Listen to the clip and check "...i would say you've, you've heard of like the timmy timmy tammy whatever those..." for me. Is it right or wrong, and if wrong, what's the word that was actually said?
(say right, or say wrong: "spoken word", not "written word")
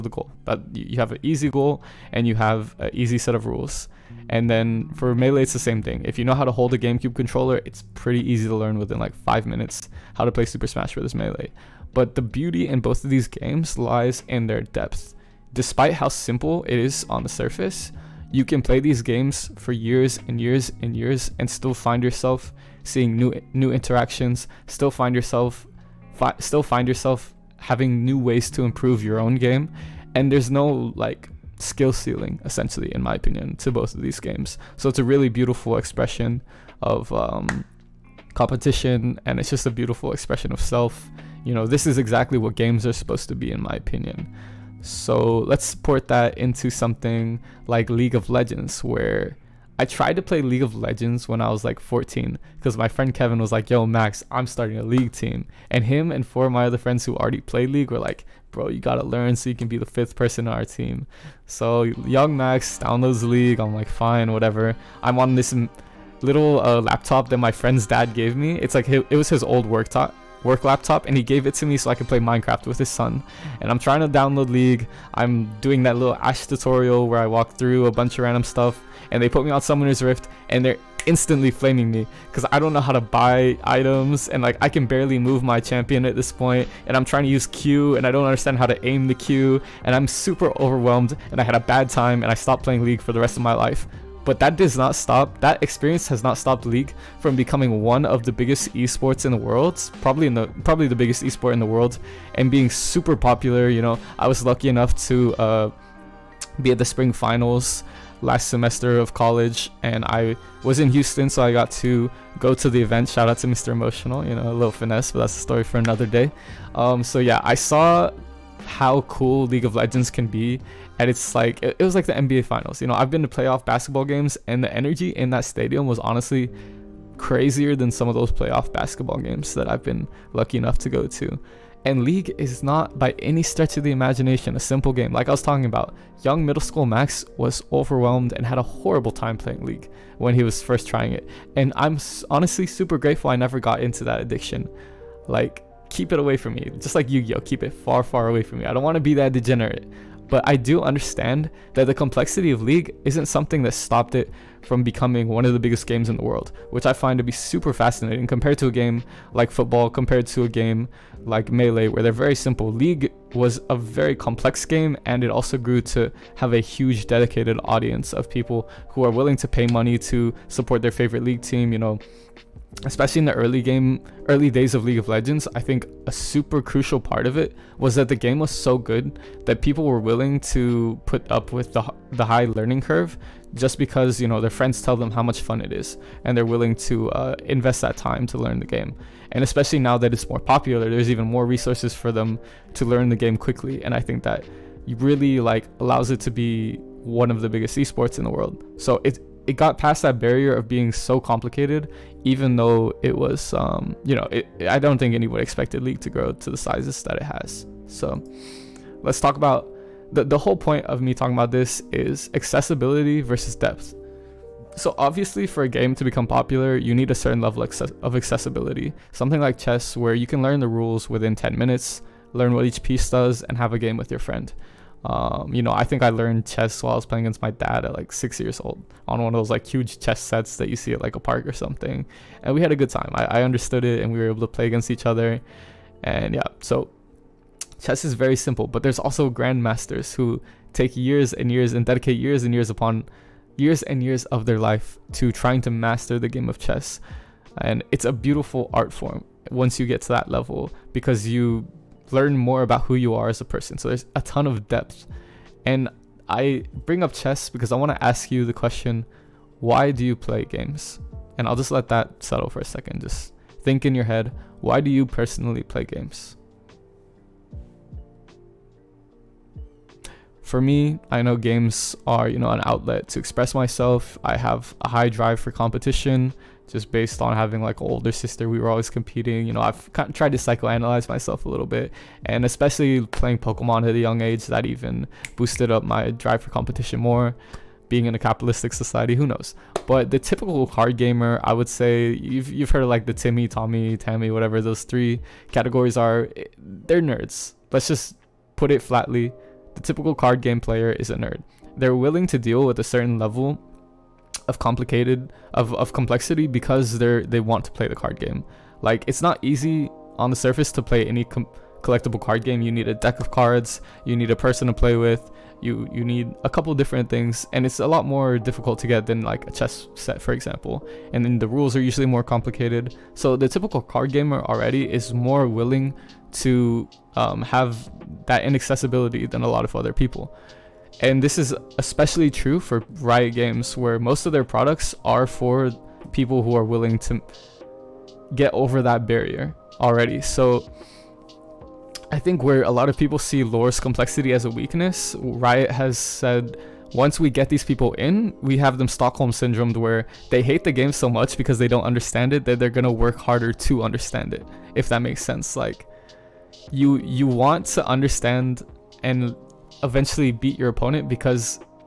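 wrong: "tommy", not "timmy".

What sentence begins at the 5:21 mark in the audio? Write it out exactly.
And then the rules are usually more complicated.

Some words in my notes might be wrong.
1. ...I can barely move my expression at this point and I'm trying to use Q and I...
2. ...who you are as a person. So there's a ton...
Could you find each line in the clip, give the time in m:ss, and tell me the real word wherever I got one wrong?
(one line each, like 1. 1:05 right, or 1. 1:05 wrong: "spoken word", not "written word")
1. 1:24 wrong: "champion", not "expression"
2. 4:12 right.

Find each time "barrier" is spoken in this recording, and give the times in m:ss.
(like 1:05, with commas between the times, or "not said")
3:20, 5:39.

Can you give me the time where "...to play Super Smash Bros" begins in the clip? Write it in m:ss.
0:10.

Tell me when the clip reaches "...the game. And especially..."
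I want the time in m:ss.
3:08.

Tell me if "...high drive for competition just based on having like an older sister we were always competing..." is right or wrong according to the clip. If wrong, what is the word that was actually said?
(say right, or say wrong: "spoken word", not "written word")
right.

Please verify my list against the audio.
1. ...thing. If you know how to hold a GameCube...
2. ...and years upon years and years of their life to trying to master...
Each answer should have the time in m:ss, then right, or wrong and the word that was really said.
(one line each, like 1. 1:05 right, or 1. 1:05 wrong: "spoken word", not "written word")
1. 0:05 right
2. 4:02 right.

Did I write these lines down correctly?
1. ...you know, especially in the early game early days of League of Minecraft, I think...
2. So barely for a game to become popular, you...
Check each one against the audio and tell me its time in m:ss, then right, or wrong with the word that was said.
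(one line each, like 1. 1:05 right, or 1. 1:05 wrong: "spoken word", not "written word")
1. 2:51 wrong: "Legends", not "Minecraft"
2. 3:34 wrong: "obviously", not "barely".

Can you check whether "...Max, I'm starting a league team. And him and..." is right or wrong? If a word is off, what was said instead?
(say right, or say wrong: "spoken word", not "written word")
right.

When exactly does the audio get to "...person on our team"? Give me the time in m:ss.
1:00.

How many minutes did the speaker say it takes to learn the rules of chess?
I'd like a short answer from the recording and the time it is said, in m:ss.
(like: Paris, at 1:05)
10, at 3:41.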